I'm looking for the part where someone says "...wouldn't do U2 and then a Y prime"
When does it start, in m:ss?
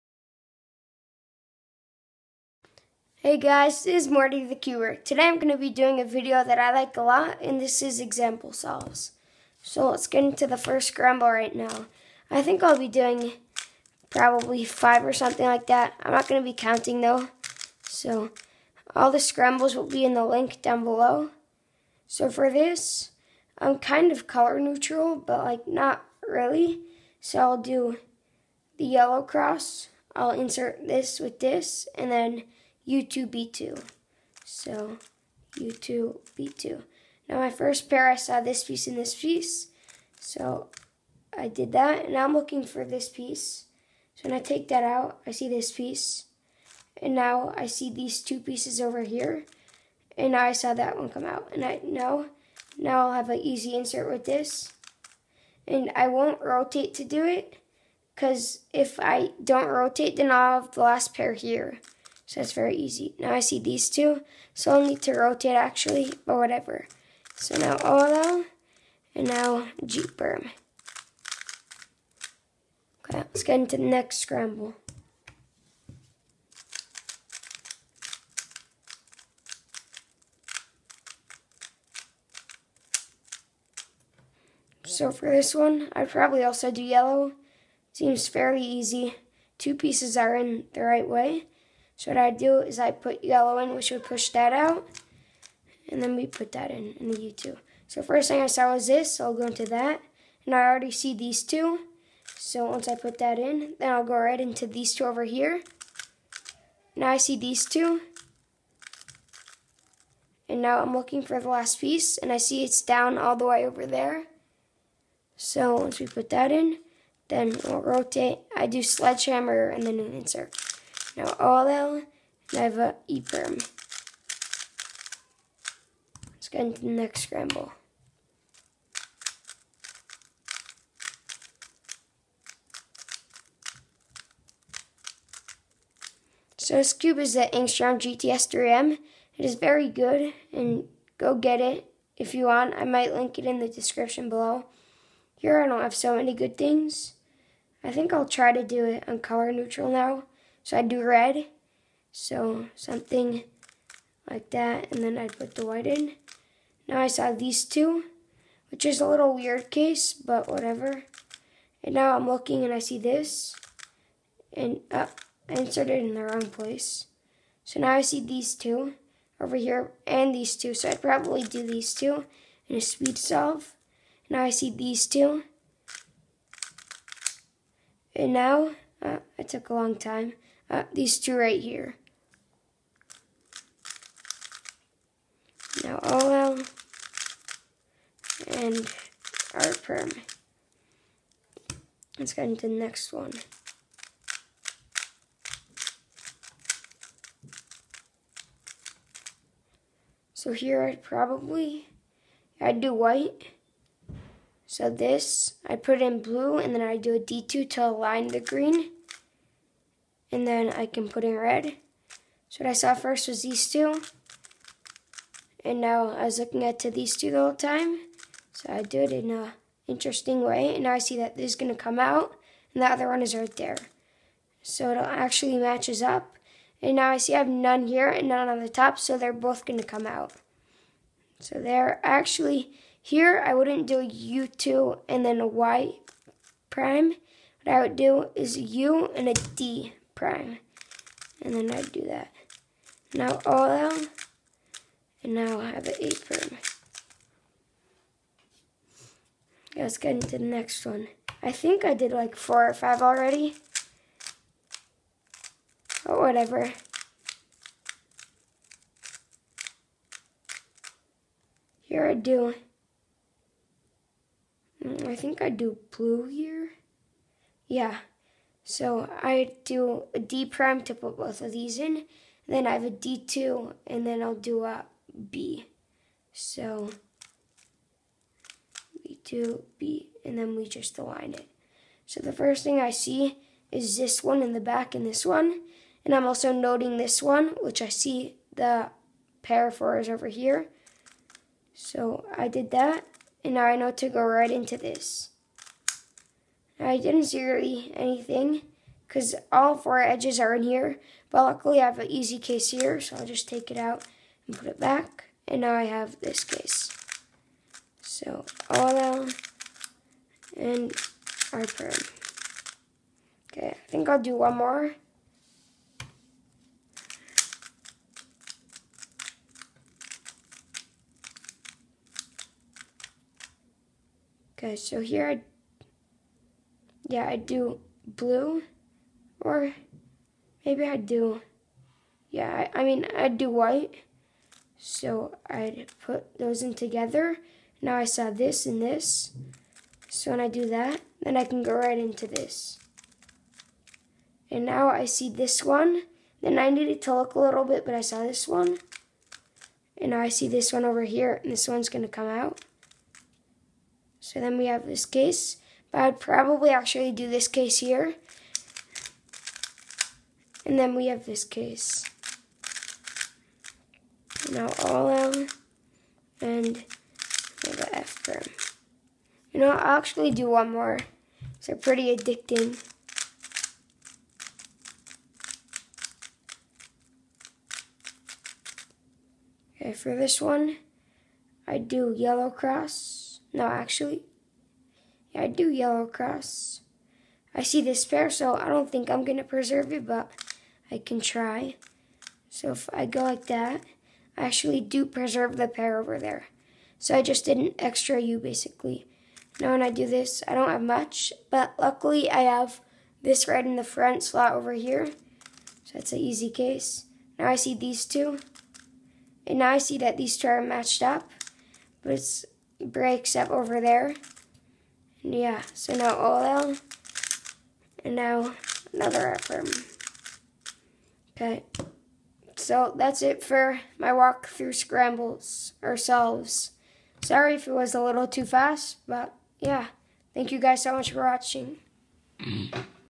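3:53.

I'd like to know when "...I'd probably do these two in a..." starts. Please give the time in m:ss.
2:50.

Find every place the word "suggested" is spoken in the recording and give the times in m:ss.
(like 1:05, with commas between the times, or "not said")
not said.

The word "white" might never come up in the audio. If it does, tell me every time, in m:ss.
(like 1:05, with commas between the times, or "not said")
2:35, 3:22, 5:33.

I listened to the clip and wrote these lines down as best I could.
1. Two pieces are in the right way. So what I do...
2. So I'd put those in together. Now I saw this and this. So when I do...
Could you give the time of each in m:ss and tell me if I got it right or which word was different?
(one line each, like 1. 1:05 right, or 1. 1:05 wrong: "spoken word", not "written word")
1. 1:29 right
2. 5:34 right.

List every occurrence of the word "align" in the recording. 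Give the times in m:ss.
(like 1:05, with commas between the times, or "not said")
3:27, 4:40.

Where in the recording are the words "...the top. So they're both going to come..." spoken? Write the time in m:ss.
3:48.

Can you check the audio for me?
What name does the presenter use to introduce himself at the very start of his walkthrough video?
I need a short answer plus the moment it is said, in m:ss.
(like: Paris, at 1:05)
Marty the Cuber, at 0:04.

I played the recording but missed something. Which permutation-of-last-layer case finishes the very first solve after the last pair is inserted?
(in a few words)
J perm.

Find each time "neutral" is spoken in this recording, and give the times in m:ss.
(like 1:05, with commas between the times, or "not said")
0:24, 2:29.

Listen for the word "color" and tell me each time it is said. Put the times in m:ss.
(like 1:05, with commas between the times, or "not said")
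0:24, 2:29.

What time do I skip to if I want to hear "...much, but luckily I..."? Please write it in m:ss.
6:40.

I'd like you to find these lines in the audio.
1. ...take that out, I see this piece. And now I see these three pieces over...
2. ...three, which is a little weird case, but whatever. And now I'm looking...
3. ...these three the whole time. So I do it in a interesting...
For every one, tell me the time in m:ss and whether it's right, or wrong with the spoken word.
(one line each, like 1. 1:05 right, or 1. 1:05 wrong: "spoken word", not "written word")
1. 0:44 wrong: "two", not "three"
2. 2:37 wrong: "two", not "three"
3. 3:36 wrong: "two", not "three".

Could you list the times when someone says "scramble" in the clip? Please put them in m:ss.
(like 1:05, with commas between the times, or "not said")
0:10, 0:19, 1:14, 2:07, 7:04.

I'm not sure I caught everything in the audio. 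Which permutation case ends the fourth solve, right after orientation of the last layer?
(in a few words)
A perm.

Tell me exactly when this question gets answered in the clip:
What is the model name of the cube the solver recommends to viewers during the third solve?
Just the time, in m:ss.
2:17.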